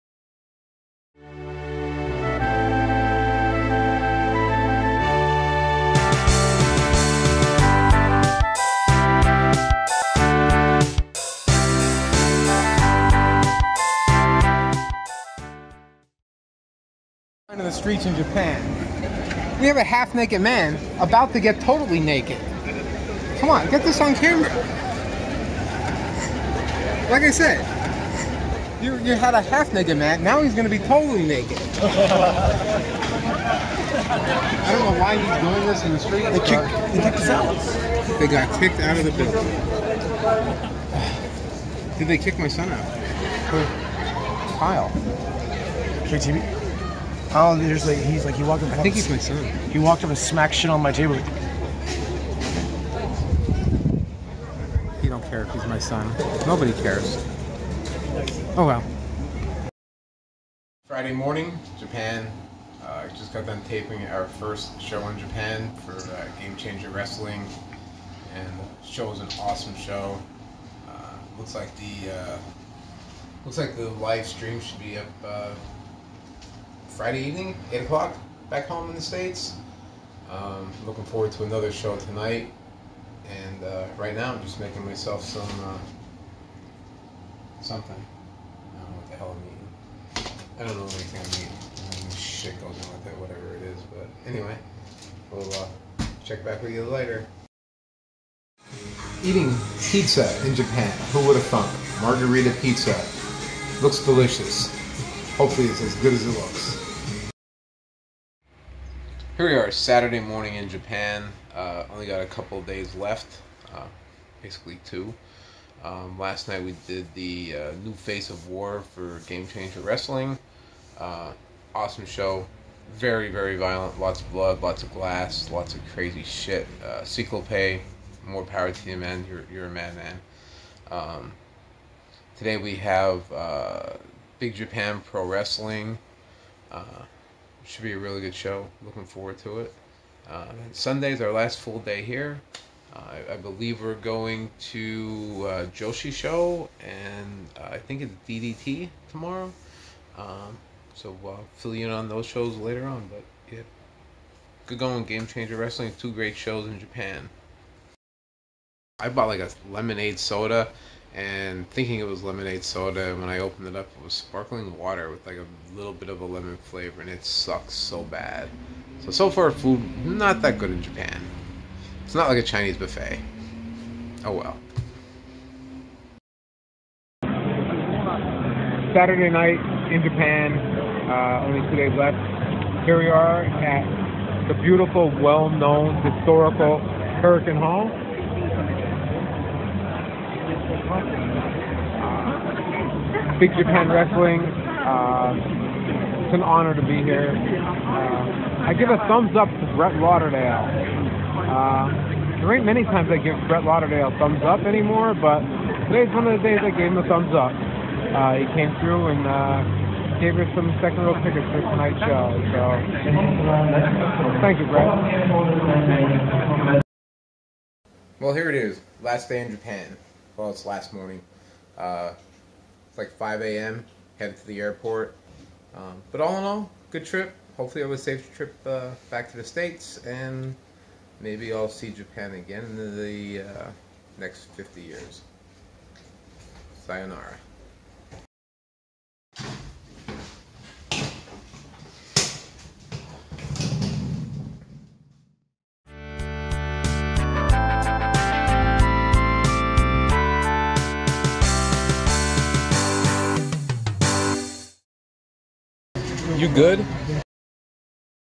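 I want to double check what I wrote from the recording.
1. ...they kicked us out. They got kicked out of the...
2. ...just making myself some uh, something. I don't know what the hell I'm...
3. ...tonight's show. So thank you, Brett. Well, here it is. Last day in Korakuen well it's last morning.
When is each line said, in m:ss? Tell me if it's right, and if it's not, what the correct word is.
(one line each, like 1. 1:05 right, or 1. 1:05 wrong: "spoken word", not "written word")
1. 0:36 right
2. 1:24 right
3. 3:31 wrong: "Japan", not "Korakuen".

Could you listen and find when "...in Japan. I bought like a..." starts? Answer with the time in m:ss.
2:36.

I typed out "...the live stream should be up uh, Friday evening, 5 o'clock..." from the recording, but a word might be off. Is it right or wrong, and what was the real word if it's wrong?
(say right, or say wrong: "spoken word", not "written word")
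wrong: "8", not "5".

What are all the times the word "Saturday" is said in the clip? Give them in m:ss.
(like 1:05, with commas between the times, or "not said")
1:49, 2:58.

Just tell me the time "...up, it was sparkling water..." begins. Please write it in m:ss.
2:43.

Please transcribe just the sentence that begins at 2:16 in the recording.
Uh, should be a really good show.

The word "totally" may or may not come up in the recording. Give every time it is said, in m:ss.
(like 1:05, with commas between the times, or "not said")
0:21, 0:30.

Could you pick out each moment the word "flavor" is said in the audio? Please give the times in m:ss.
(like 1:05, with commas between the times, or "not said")
2:46.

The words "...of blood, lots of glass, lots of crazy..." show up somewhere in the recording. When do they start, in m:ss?
2:04.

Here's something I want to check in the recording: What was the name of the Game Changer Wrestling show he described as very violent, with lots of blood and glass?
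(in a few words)
New Face of War.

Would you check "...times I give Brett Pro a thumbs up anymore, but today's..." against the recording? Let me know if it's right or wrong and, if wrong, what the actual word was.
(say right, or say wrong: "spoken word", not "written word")
wrong: "Lauderdale", not "Pro".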